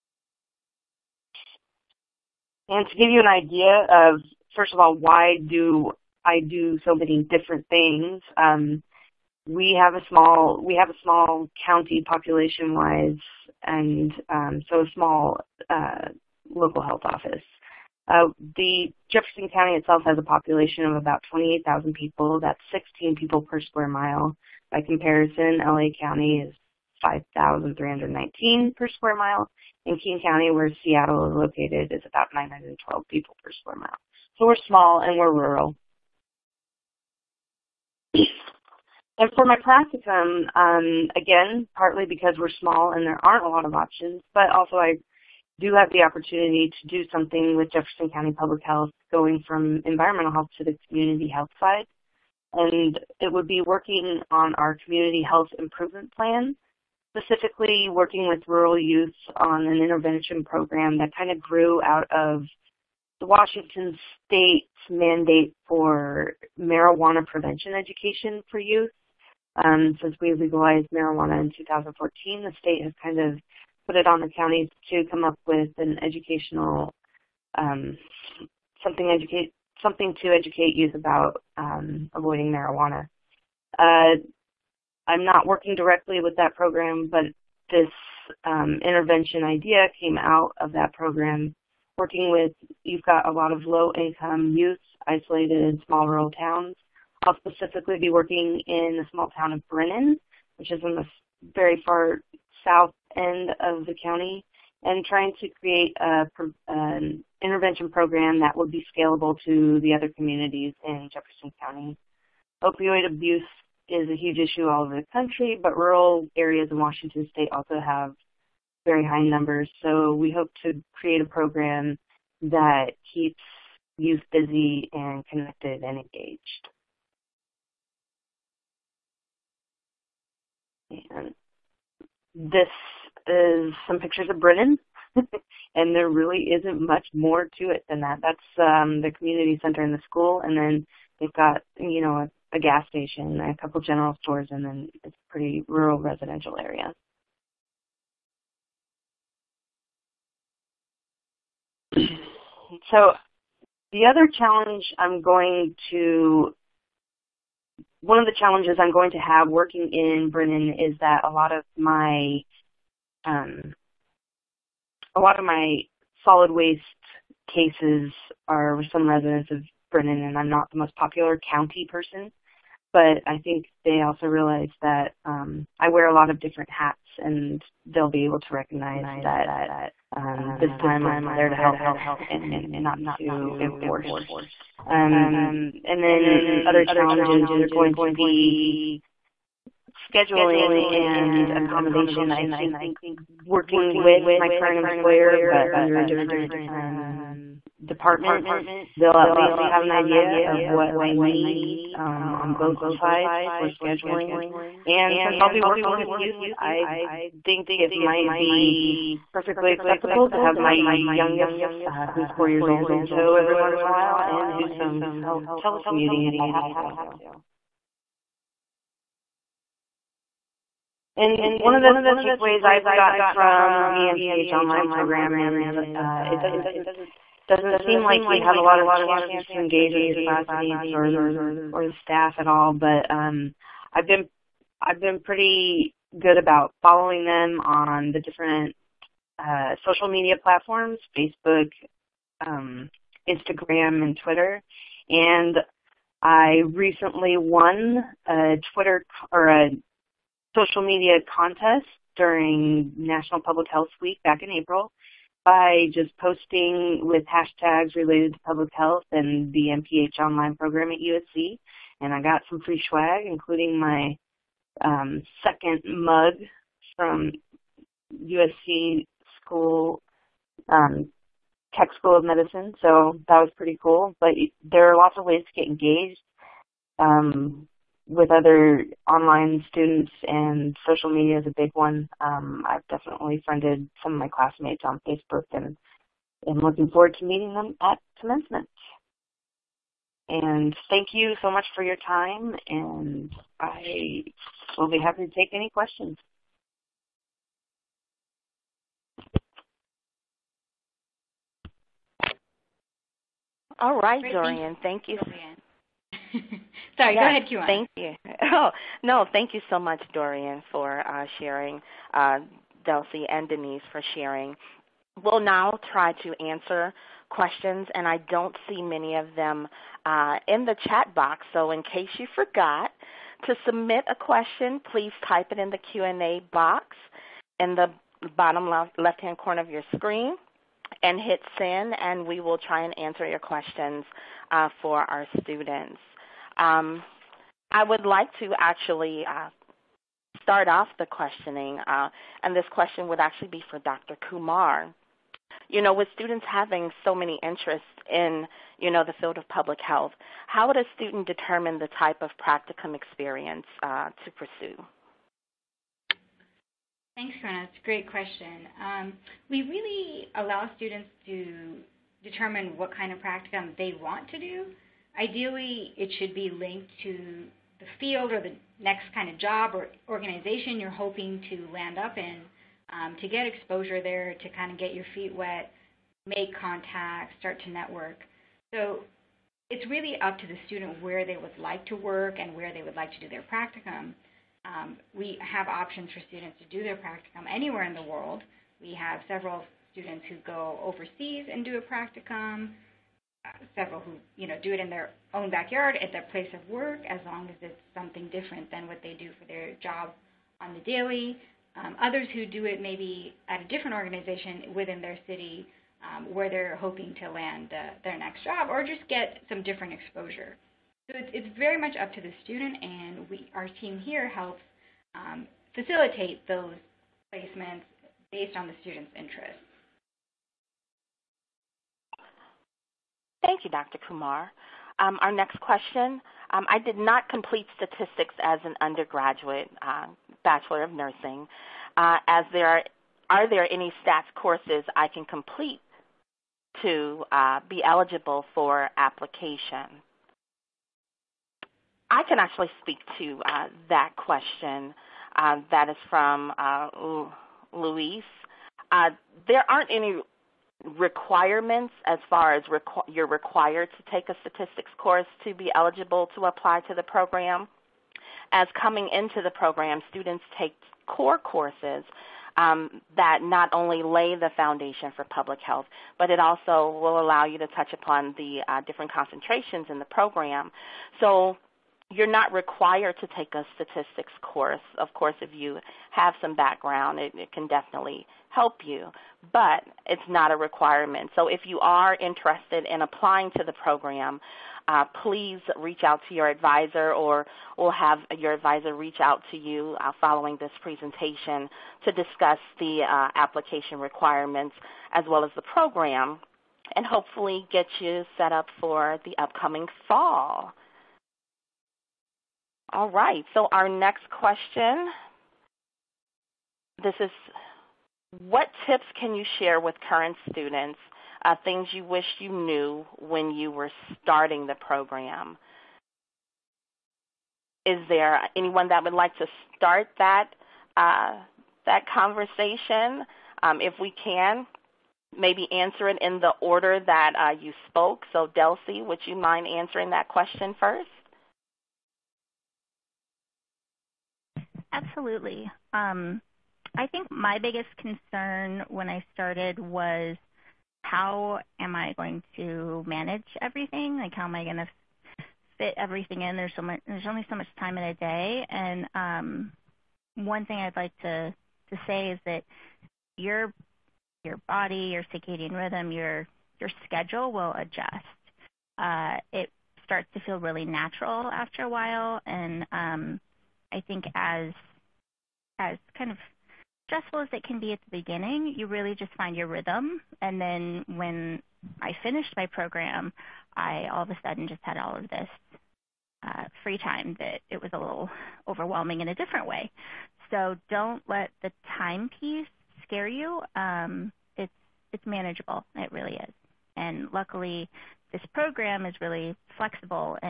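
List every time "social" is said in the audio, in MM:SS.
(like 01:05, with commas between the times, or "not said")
03:59, 04:10, 04:40.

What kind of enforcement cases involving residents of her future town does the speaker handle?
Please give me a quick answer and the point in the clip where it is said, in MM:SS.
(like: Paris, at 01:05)
solid waste cases, at 02:46.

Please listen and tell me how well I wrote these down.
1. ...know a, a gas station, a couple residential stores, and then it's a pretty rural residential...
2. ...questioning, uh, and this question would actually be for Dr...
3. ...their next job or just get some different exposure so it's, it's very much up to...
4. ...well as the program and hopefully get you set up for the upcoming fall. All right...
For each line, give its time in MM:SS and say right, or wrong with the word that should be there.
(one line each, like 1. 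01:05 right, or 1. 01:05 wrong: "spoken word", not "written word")
1. 02:22 wrong: "general", not "residential"
2. 05:41 right
3. 06:48 right
4. 08:15 right.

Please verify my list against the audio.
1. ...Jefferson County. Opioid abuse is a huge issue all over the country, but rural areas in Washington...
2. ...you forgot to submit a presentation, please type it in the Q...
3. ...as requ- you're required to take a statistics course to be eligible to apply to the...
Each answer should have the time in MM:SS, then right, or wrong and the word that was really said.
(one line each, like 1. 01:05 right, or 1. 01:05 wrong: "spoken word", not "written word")
1. 01:51 right
2. 05:22 wrong: "question", not "presentation"
3. 07:32 right.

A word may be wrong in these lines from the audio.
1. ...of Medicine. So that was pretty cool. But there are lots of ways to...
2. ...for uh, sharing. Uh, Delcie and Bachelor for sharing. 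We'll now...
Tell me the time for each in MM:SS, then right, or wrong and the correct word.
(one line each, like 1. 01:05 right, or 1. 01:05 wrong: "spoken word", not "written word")
1. 04:32 right
2. 05:10 wrong: "Deniz", not "Bachelor".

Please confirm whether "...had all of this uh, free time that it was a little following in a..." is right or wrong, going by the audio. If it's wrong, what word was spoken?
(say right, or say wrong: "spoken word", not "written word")
wrong: "overwhelming", not "following".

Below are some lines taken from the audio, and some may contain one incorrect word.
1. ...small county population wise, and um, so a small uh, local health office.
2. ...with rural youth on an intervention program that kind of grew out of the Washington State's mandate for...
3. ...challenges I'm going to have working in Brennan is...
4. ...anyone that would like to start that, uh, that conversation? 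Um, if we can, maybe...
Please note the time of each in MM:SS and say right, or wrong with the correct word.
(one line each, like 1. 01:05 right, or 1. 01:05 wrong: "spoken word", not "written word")
1. 00:11 right
2. 00:58 right
3. 02:38 right
4. 08:38 right.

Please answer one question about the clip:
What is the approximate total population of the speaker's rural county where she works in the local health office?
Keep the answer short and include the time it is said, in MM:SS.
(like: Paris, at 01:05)
28,000, at 00:21.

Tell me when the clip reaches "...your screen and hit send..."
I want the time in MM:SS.
05:29.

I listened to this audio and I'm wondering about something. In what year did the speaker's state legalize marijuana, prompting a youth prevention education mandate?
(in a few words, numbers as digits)
2014.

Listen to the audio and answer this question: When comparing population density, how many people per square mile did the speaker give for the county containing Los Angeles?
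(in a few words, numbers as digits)
5,319.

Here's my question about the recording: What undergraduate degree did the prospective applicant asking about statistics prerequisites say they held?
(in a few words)
Bachelor of Nursing.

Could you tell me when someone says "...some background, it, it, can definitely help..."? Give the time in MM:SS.
07:56.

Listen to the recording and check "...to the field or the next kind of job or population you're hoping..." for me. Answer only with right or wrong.
wrong.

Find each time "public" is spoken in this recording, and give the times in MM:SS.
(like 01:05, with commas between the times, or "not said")
00:48, 04:13, 04:18, 05:49, 07:45.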